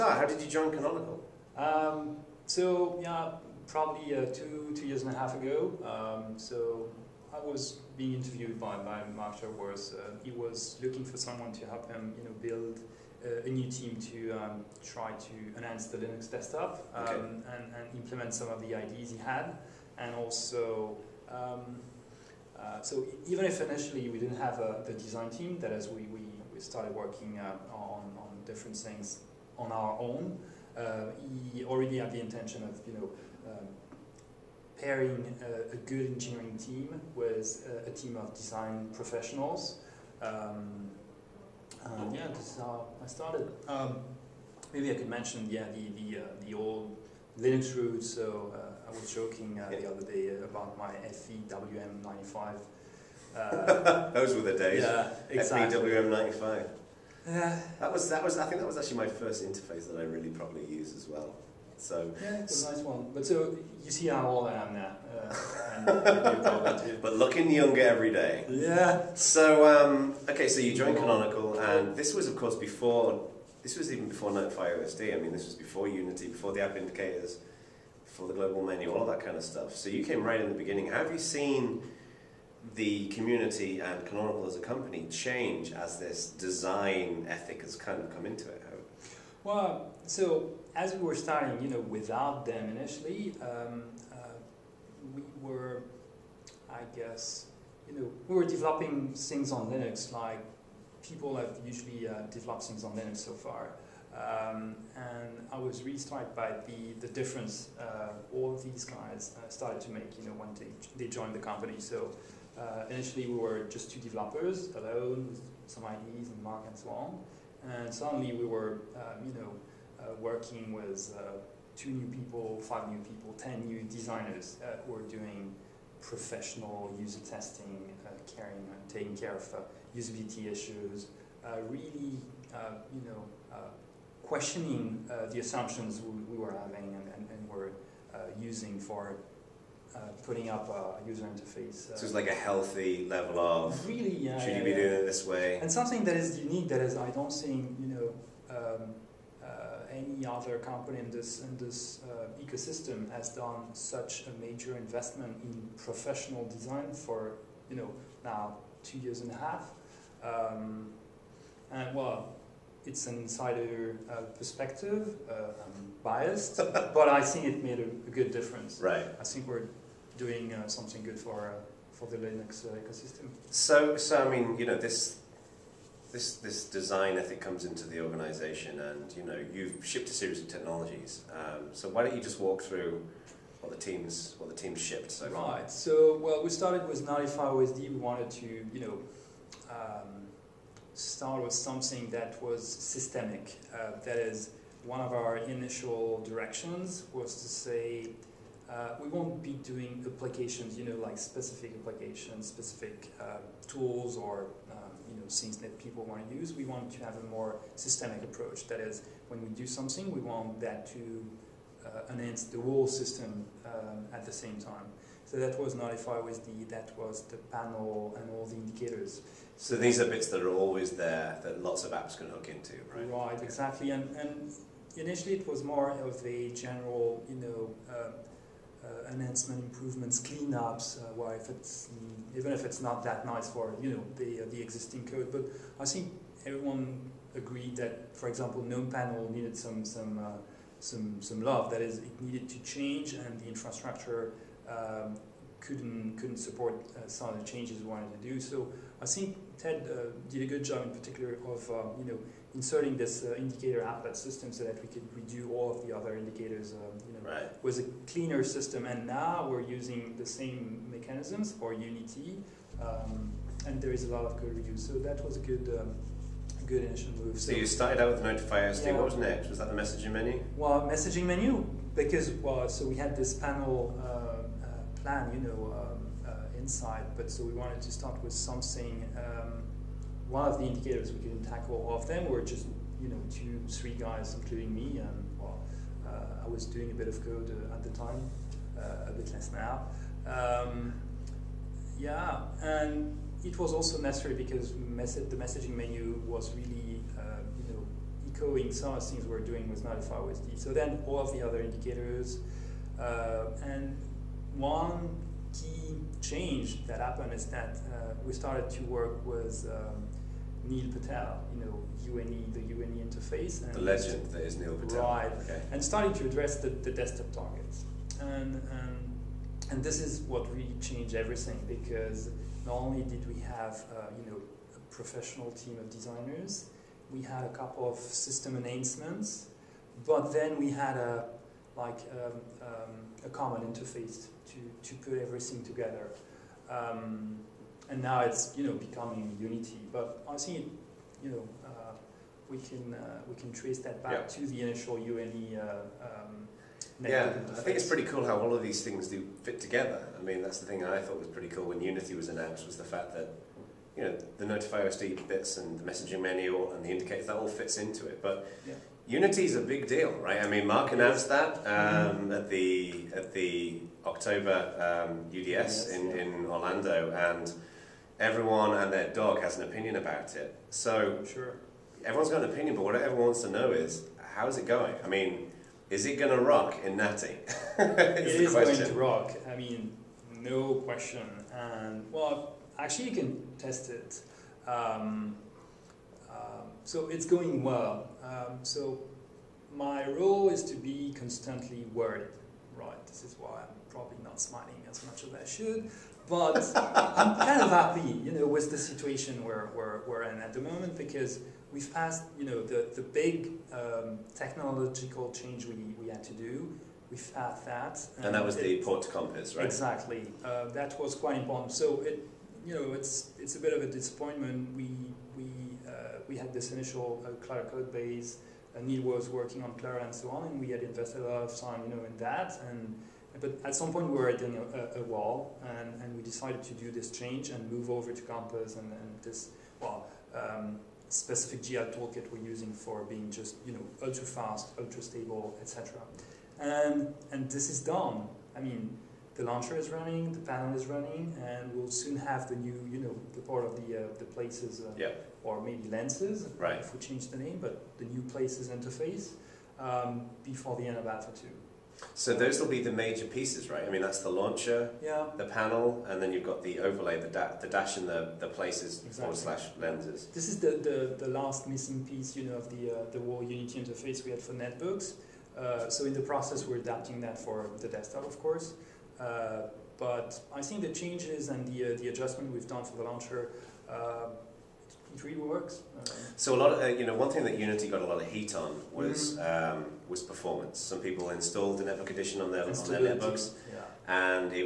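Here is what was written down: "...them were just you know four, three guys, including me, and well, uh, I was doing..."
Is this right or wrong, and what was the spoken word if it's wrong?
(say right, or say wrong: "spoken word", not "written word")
wrong: "two", not "four".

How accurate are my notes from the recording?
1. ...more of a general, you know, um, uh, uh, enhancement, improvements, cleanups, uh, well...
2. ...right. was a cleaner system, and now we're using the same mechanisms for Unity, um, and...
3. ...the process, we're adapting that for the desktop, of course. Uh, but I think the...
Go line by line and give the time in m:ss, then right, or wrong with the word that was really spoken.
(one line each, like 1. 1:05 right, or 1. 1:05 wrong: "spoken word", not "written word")
1. 3:45 right
2. 4:17 right
3. 7:46 right.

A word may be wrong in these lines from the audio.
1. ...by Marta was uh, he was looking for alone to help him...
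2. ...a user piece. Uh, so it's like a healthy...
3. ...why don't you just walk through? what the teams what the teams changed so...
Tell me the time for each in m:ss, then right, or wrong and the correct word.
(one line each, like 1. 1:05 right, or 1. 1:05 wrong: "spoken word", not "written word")
1. 0:08 wrong: "someone", not "alone"
2. 2:20 wrong: "interface", not "piece"
3. 3:01 wrong: "shipped", not "changed".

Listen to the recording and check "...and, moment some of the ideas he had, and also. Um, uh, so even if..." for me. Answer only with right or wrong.
wrong.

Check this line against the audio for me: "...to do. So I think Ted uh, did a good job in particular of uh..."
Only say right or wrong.
right.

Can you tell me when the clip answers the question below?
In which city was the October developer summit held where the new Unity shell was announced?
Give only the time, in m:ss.
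6:06.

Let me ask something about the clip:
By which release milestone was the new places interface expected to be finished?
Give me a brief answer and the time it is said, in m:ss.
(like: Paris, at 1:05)
Alpha 2, at 7:31.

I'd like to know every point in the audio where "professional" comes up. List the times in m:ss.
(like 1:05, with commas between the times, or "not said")
0:38, 2:06, 2:35, 5:24.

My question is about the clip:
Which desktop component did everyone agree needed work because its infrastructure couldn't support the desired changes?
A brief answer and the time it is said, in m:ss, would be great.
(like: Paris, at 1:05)
GNOME panel, at 3:58.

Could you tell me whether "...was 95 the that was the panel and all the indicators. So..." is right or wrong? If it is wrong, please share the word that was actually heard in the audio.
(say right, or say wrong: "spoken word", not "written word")
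right.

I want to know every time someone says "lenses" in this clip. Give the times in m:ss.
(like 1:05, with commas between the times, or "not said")
7:25, 7:39.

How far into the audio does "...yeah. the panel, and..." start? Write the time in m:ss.
7:35.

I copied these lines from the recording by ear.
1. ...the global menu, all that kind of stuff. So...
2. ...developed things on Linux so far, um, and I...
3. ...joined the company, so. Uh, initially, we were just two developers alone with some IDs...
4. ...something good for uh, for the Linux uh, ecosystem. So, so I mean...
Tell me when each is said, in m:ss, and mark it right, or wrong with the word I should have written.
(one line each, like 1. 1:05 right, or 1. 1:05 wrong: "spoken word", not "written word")
1. 1:18 right
2. 1:42 right
3. 1:51 right
4. 2:50 right.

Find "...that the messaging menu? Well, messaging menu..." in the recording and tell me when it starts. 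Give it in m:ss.
4:29.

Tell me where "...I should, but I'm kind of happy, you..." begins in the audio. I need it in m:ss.
6:35.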